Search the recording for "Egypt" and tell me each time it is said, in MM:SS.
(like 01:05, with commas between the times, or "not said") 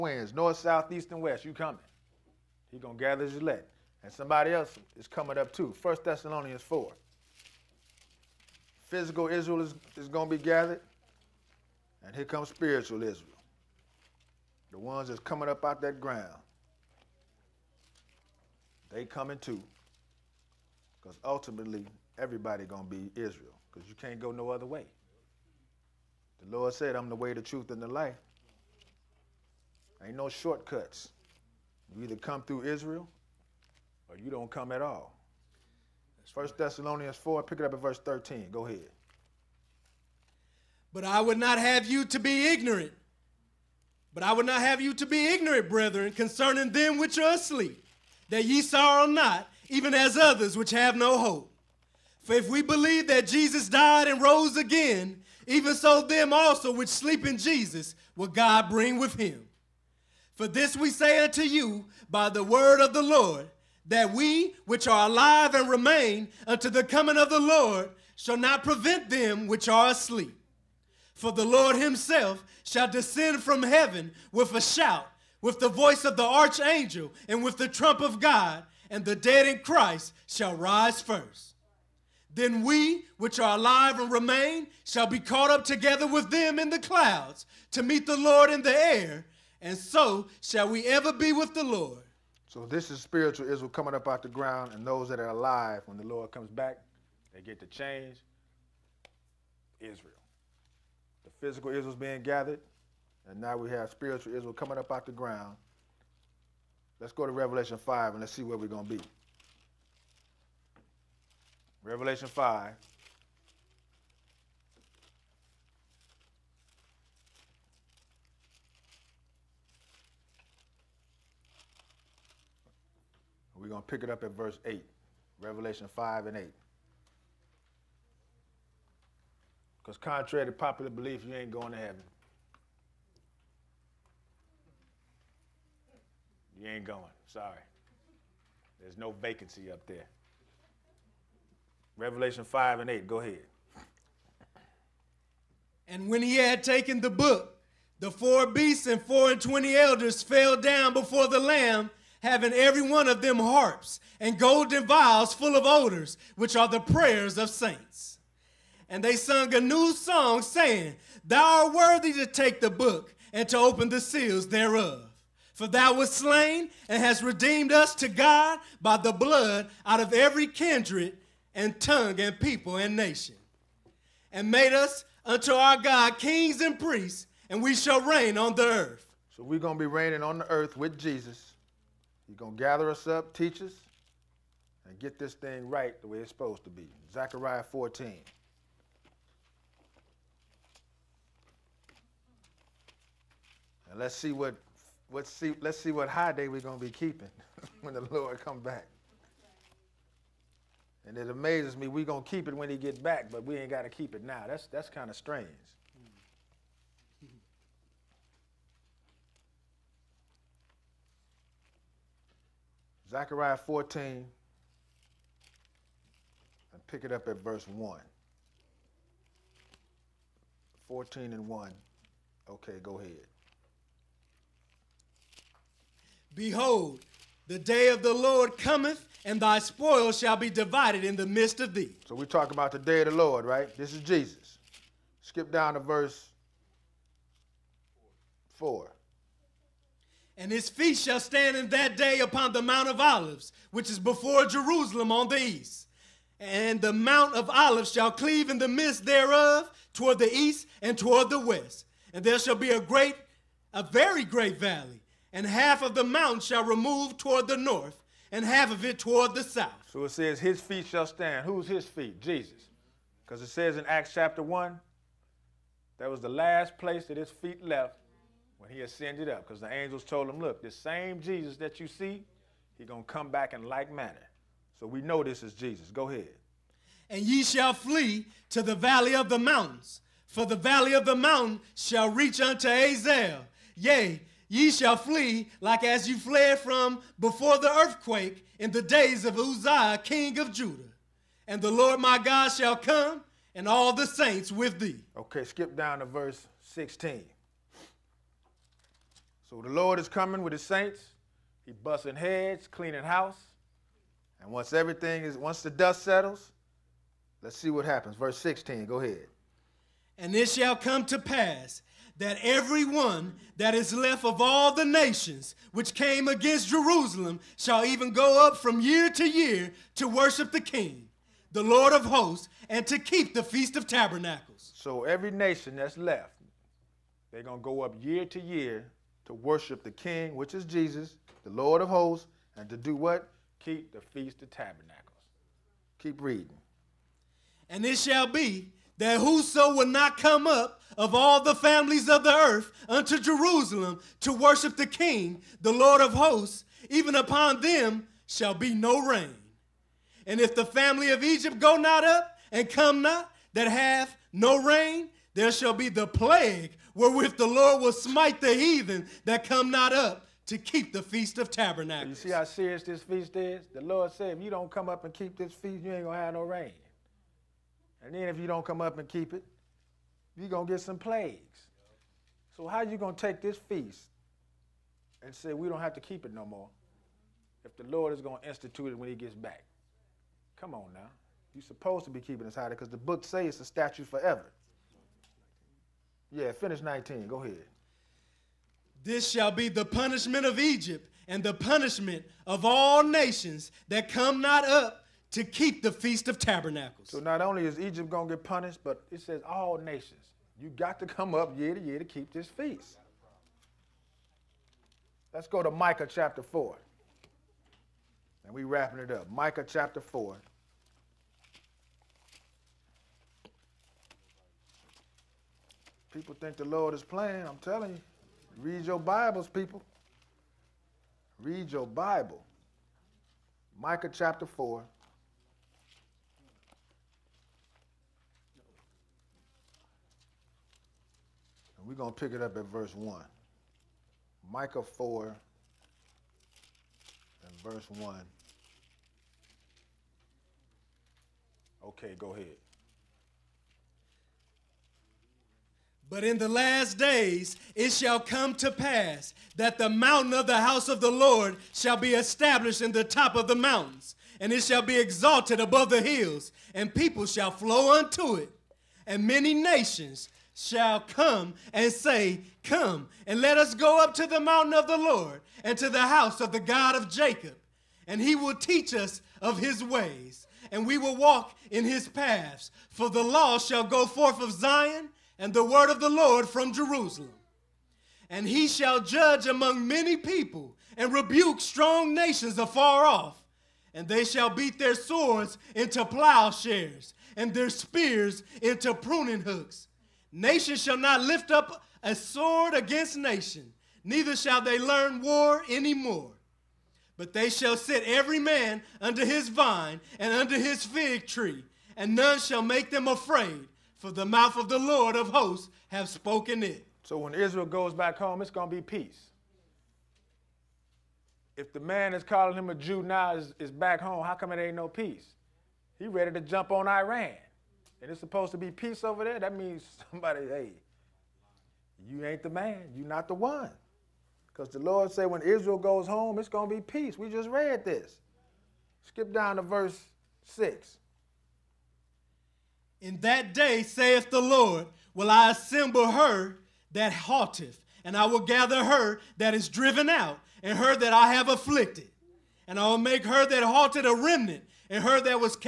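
05:51, 06:30, 06:37.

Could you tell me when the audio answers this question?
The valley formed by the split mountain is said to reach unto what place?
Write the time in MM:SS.
04:42.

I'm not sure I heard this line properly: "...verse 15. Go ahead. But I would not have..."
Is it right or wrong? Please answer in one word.
wrong.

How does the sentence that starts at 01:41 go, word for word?
The physical Israel's being gathered, and now we have spiritual Israel coming up out the ground.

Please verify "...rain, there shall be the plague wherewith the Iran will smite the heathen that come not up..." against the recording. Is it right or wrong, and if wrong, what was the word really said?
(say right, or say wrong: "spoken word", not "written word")
wrong: "Lord", not "Iran".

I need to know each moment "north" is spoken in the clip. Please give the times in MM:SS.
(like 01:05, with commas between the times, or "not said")
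00:00, 04:17.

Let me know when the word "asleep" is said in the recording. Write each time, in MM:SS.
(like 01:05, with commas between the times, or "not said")
00:47, 01:09.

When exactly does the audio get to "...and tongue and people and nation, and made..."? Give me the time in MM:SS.
02:51.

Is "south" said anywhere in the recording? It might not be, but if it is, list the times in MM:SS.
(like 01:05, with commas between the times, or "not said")
00:00, 04:19.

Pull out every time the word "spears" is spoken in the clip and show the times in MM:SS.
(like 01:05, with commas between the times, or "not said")
08:07.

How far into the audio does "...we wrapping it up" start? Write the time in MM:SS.
06:48.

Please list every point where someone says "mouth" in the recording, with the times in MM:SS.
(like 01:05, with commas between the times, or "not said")
08:24.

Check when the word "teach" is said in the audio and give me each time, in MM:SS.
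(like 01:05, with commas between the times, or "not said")
03:03, 07:48.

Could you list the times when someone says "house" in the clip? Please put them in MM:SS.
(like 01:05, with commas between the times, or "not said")
05:03, 07:30, 07:46.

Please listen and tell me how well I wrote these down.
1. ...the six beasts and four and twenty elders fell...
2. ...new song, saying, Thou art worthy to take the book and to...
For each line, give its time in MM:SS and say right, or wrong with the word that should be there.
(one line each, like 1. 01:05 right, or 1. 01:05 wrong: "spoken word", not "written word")
1. 02:27 wrong: "four", not "six"
2. 02:39 right.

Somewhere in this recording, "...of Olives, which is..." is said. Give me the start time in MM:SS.
04:02.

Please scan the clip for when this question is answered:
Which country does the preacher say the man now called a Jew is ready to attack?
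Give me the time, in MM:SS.
08:36.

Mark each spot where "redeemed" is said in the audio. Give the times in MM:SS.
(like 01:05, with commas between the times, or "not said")
02:47.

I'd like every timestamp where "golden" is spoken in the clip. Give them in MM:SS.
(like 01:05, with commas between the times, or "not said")
02:34.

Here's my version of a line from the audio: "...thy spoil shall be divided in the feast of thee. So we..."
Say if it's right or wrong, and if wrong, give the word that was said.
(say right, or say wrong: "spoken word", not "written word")
wrong: "midst", not "feast".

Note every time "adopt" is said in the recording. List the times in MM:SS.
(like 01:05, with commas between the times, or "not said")
not said.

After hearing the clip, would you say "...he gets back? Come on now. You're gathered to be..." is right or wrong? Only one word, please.
wrong.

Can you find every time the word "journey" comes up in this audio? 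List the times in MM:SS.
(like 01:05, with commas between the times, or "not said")
not said.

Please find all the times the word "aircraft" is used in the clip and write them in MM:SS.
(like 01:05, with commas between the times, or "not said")
not said.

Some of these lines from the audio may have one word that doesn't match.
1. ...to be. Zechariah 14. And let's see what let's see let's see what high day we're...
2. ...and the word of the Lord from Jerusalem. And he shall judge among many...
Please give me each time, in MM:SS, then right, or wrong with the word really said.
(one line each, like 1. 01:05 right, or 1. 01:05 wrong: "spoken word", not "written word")
1. 03:06 right
2. 07:55 right.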